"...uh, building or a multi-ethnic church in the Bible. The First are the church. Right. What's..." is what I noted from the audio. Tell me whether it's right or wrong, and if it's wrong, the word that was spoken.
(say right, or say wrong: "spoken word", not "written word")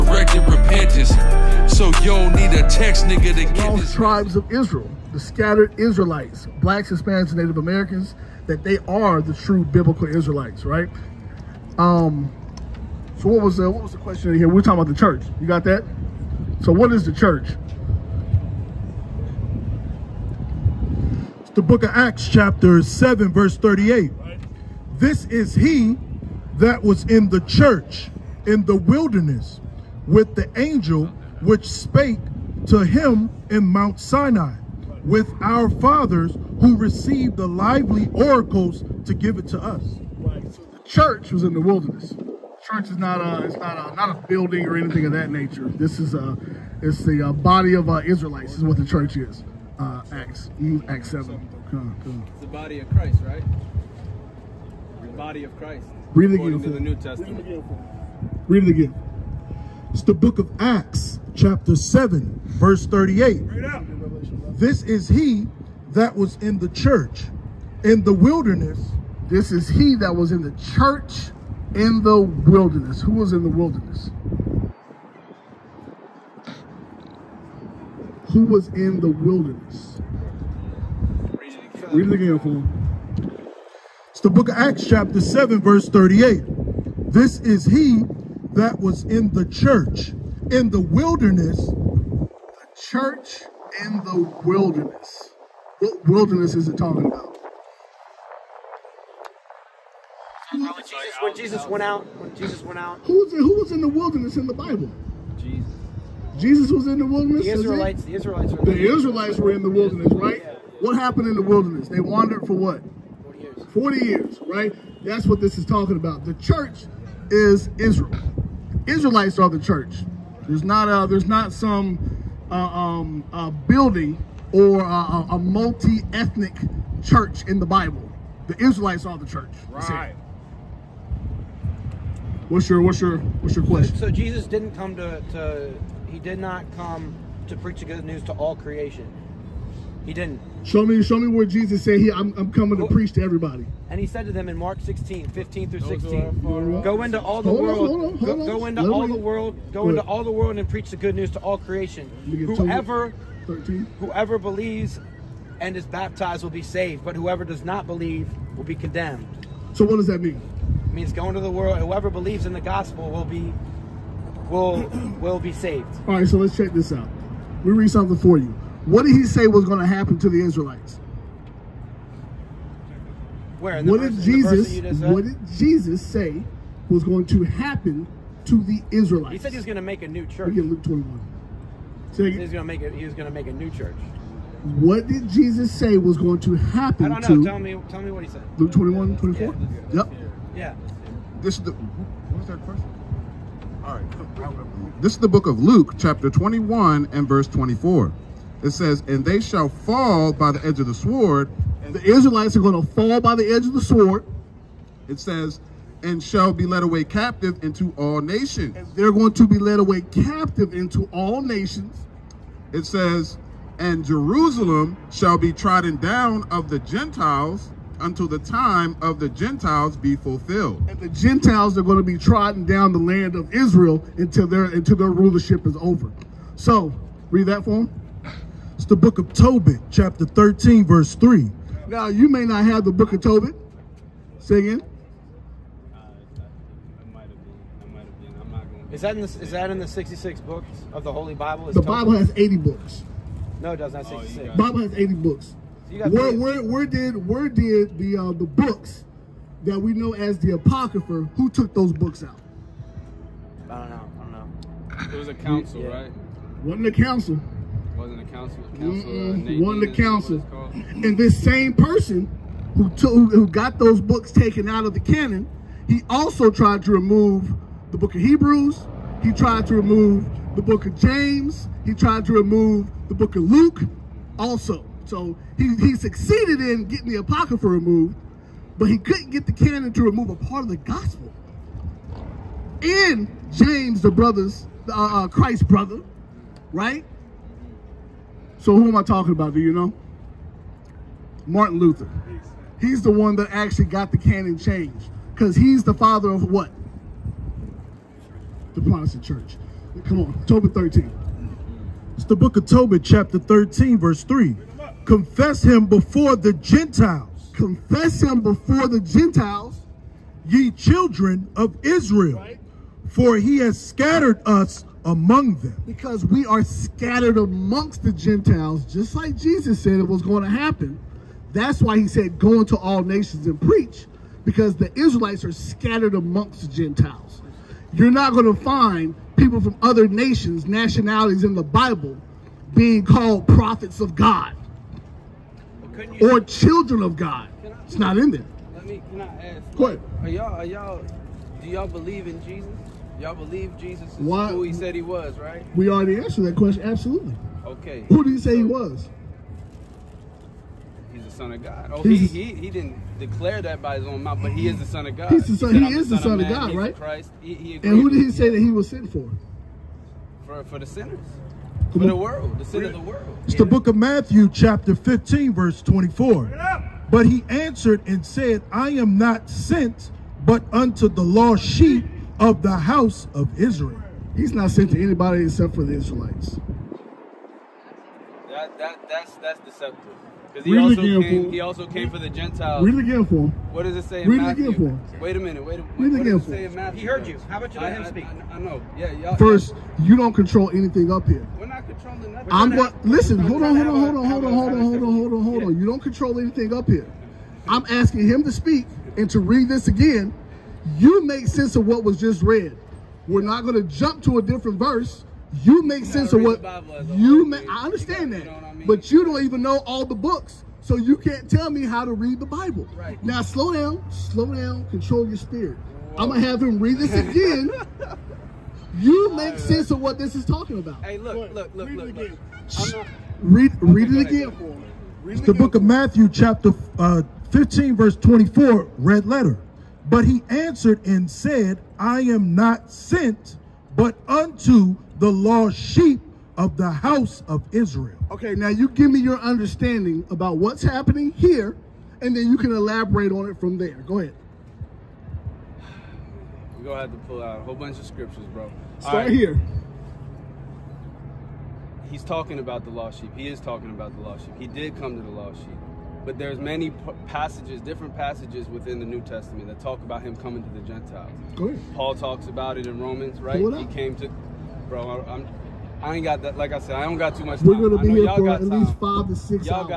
wrong: "Israelites", not "First".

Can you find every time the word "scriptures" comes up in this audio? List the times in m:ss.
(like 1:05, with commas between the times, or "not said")
7:28.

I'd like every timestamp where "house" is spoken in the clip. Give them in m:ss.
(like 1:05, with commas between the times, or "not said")
6:12, 7:16.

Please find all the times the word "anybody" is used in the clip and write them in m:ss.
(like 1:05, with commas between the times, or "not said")
6:15.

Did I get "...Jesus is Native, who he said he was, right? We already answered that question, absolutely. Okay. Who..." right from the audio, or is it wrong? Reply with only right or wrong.
wrong.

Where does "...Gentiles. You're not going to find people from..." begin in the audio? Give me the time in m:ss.
5:26.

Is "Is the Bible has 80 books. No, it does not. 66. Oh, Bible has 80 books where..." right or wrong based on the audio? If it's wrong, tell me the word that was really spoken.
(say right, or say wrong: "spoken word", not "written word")
right.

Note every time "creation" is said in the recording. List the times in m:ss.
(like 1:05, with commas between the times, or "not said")
2:18, 2:31.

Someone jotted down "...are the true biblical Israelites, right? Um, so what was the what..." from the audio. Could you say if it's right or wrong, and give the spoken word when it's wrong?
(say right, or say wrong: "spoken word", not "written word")
right.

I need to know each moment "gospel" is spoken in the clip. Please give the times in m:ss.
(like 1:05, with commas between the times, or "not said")
2:42, 4:40.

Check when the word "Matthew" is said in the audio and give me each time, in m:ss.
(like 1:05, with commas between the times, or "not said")
6:03, 6:24, 7:05.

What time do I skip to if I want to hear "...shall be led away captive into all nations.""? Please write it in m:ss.
3:26.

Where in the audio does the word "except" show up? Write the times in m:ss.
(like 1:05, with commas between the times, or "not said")
6:15.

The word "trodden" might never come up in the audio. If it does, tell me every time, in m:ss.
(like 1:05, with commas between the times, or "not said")
3:35, 3:42.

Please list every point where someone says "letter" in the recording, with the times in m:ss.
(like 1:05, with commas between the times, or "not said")
7:09.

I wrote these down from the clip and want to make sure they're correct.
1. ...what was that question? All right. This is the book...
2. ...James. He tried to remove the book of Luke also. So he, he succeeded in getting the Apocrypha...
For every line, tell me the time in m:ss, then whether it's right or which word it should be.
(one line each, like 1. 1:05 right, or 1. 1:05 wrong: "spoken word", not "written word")
1. 3:11 right
2. 4:30 right.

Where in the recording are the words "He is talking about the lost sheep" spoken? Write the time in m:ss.
7:33.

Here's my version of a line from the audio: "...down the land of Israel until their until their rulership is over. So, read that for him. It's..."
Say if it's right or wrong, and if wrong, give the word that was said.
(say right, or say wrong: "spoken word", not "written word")
right.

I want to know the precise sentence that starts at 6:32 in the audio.
I'm going listen, hold on, hold on, hold on, hold on, hold on, hold on, hold on, hold on.